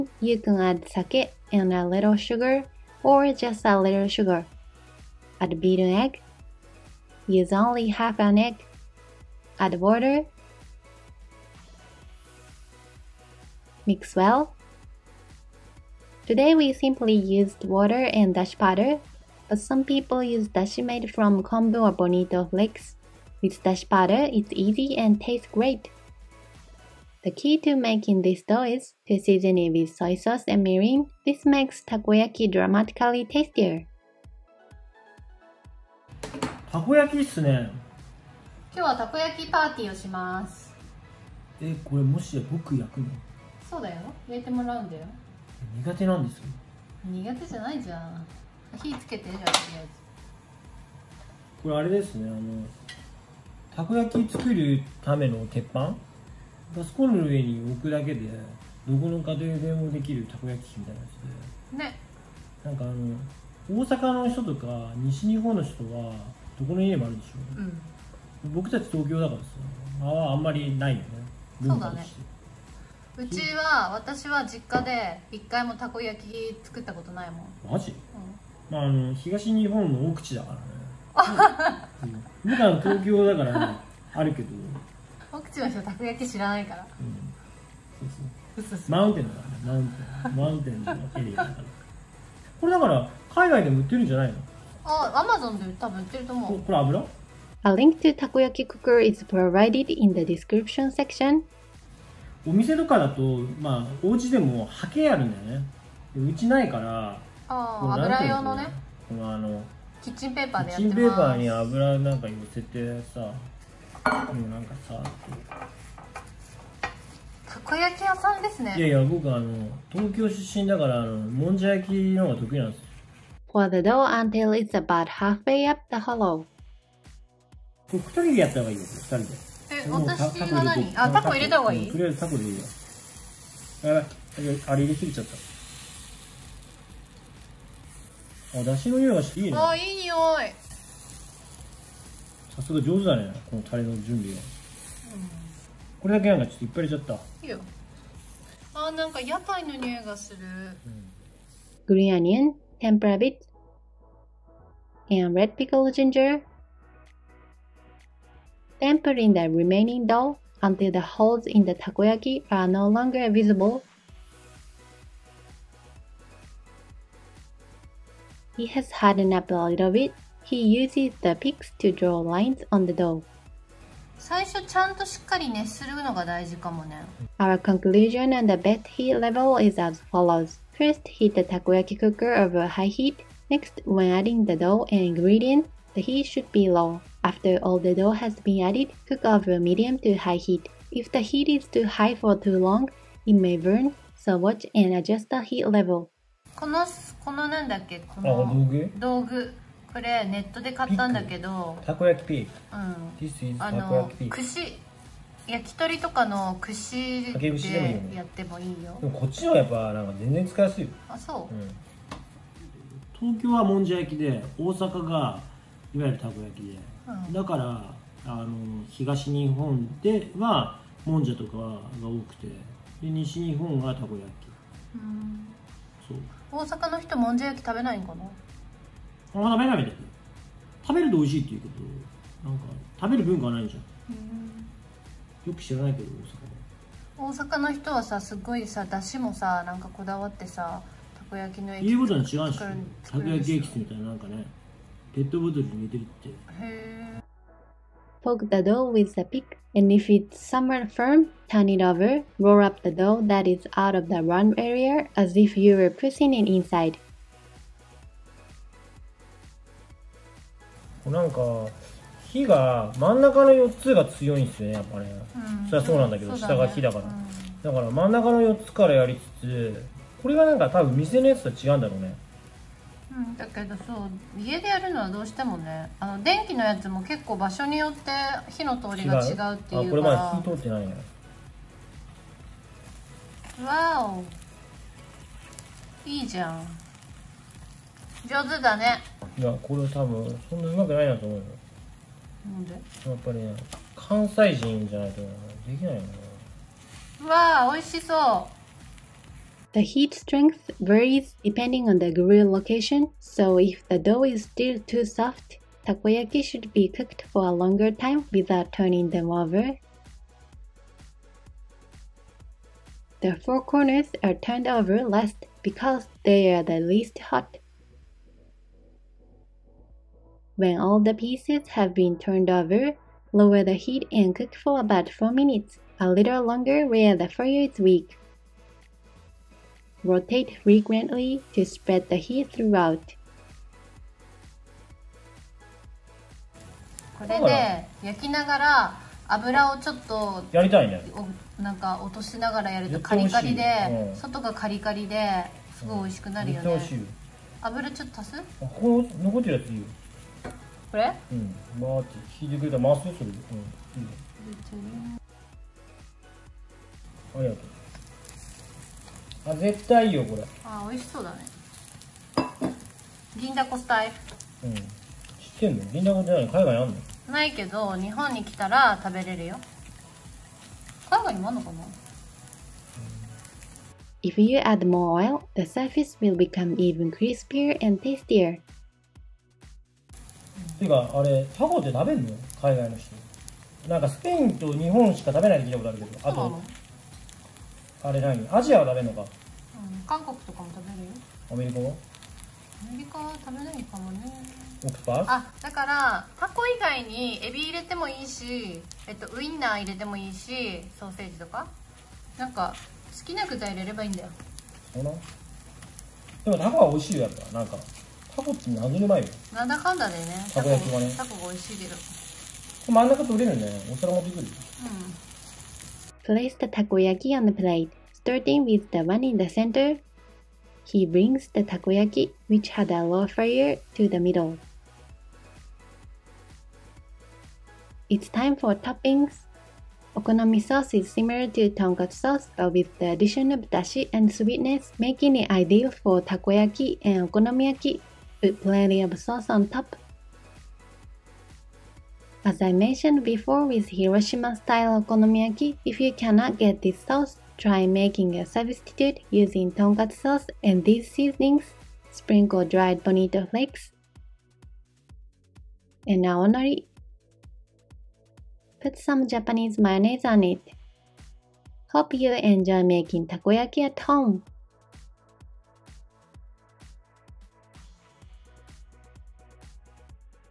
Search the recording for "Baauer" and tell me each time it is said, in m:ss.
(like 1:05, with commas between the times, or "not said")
not said.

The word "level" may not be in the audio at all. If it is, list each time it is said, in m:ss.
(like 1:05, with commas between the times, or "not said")
2:59, 3:15.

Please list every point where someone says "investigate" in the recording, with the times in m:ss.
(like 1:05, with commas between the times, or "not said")
not said.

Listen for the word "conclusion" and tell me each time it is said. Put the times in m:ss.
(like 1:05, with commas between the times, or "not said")
2:57.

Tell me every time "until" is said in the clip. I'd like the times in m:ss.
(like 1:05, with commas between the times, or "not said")
2:04, 2:40.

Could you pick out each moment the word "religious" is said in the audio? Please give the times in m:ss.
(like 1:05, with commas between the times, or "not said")
not said.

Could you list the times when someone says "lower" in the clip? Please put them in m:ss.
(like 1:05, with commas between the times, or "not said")
5:23.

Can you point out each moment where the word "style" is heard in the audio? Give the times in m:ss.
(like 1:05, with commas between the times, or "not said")
7:24.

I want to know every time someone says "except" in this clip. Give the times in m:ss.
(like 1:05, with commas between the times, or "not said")
not said.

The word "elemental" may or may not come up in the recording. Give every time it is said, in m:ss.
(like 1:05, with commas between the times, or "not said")
not said.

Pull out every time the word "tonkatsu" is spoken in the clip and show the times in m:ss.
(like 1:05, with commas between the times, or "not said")
7:11, 7:29.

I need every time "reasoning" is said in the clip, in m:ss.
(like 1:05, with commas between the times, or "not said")
not said.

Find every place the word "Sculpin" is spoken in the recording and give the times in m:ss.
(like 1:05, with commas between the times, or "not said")
not said.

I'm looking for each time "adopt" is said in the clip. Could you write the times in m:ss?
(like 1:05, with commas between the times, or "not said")
not said.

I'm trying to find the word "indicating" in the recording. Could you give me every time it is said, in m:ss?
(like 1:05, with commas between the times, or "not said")
not said.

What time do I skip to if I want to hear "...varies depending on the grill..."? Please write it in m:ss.
5:00.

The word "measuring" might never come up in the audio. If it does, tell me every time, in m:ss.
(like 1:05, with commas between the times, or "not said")
not said.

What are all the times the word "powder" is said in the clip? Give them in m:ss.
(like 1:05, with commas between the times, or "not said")
0:18, 0:23.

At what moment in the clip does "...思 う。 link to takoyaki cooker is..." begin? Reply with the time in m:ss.
1:36.